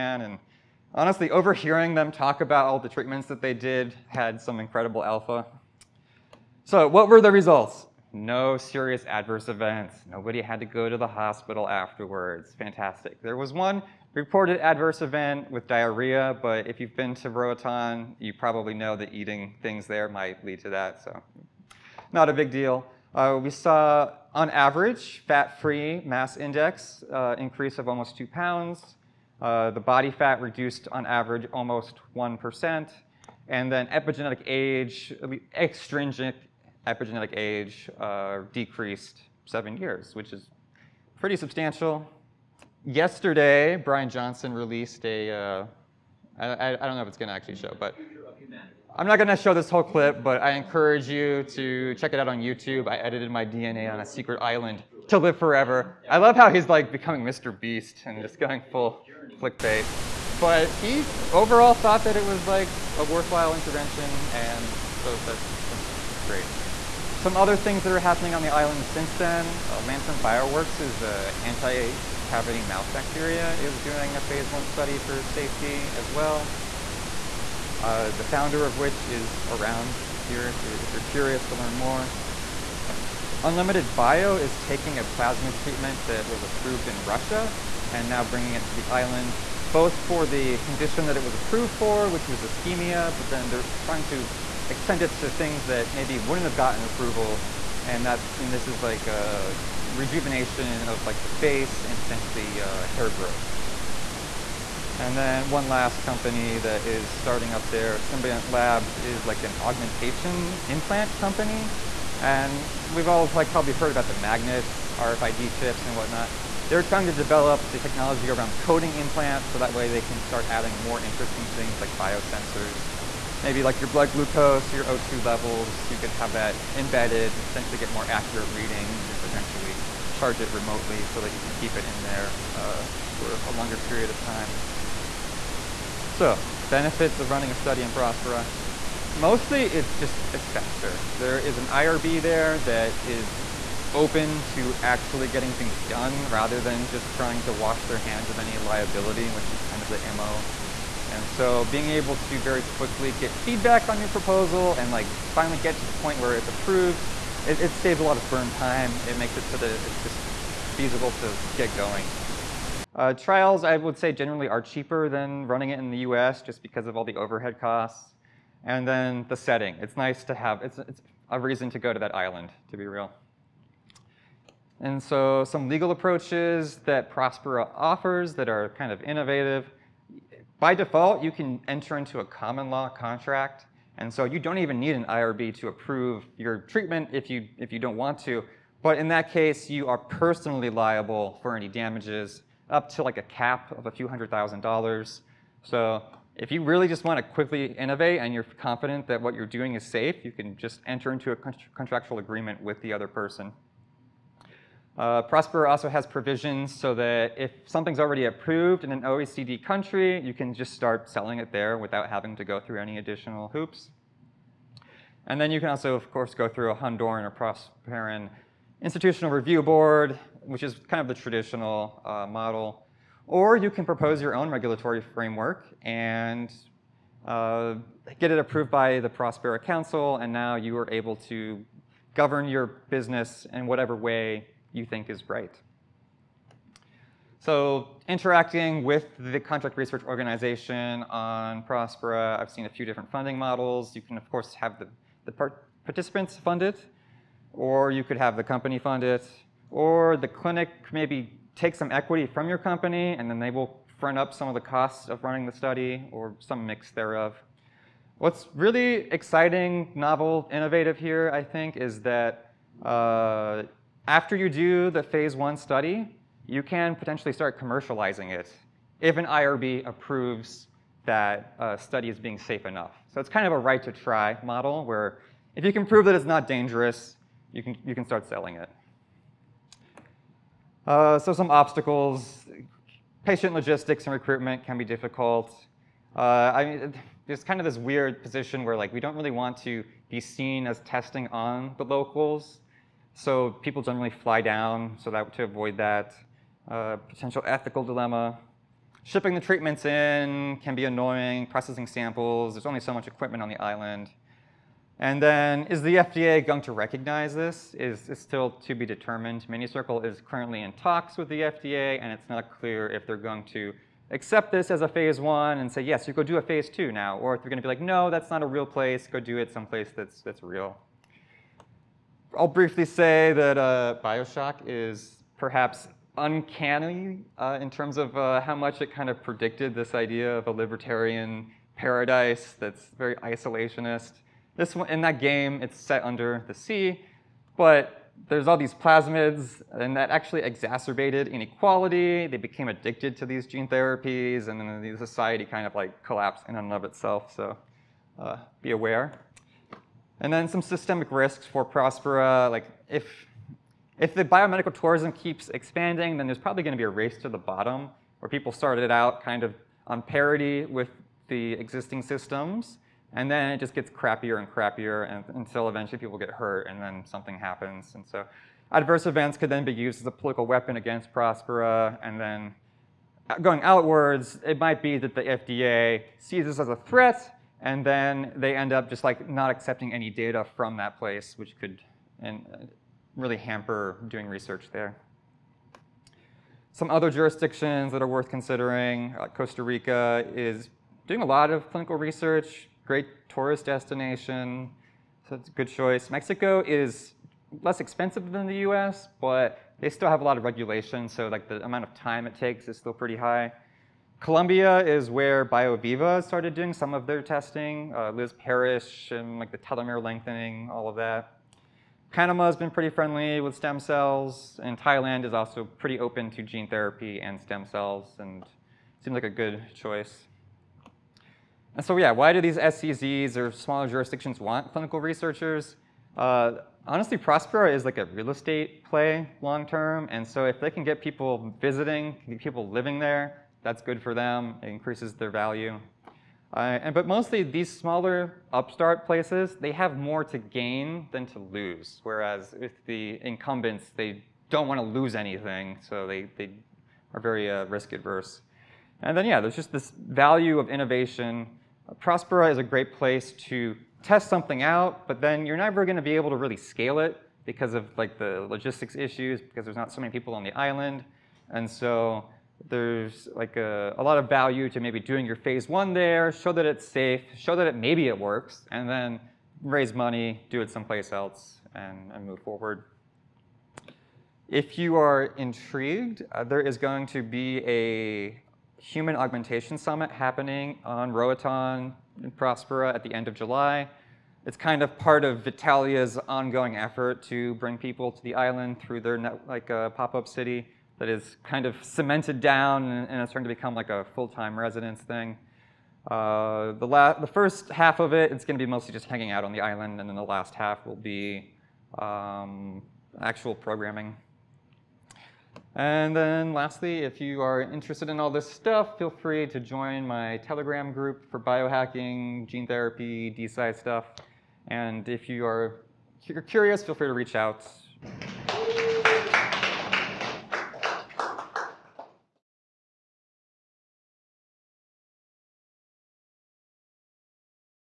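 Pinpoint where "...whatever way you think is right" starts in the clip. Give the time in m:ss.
3:53.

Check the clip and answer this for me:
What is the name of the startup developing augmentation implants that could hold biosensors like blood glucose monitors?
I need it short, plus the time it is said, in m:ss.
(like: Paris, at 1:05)
Symbiont Labs, at 1:47.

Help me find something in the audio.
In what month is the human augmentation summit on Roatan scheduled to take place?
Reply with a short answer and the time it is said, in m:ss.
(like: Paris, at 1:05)
July, at 8:03.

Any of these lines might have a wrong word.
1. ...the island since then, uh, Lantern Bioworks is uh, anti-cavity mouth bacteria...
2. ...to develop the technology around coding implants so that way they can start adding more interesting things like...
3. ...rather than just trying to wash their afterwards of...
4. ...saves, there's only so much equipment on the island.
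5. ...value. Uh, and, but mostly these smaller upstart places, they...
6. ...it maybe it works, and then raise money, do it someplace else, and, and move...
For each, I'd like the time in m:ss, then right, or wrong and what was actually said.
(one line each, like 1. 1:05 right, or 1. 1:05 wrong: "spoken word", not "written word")
1. 1:08 right
2. 1:57 right
3. 2:26 wrong: "hands", not "afterwards"
4. 5:01 wrong: "samples", not "saves"
5. 7:15 right
6. 7:47 right.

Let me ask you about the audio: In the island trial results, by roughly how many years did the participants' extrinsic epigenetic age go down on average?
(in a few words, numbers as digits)
7 years.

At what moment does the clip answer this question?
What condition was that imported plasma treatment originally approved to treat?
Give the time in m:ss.
1:32.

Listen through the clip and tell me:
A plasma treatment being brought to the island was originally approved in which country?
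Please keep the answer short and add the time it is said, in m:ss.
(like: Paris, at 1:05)
Russia, at 1:27.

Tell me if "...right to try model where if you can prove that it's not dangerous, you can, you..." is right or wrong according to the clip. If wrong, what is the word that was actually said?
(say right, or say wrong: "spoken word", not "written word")
right.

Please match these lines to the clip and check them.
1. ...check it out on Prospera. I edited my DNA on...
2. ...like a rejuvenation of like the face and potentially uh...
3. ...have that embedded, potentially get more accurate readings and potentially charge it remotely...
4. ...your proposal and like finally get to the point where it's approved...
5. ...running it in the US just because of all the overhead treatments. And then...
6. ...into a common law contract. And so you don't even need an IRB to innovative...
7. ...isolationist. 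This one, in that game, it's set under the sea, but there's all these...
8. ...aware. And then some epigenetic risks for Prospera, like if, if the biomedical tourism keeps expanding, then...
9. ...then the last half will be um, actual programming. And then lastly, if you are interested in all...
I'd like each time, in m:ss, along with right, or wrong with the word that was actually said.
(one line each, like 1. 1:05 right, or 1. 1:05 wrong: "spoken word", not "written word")
1. 0:51 wrong: "YouTube", not "Prospera"
2. 1:38 right
3. 2:06 right
4. 2:33 right
5. 2:45 wrong: "costs", not "treatments"
6. 3:01 wrong: "approve", not "innovative"
7. 5:33 right
8. 5:48 wrong: "systemic", not "epigenetic"
9. 8:20 right.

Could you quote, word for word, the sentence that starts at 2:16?
So benefits of running a study in Prospera.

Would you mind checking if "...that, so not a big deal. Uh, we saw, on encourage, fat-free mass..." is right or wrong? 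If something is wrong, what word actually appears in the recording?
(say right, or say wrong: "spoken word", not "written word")
wrong: "average", not "encourage".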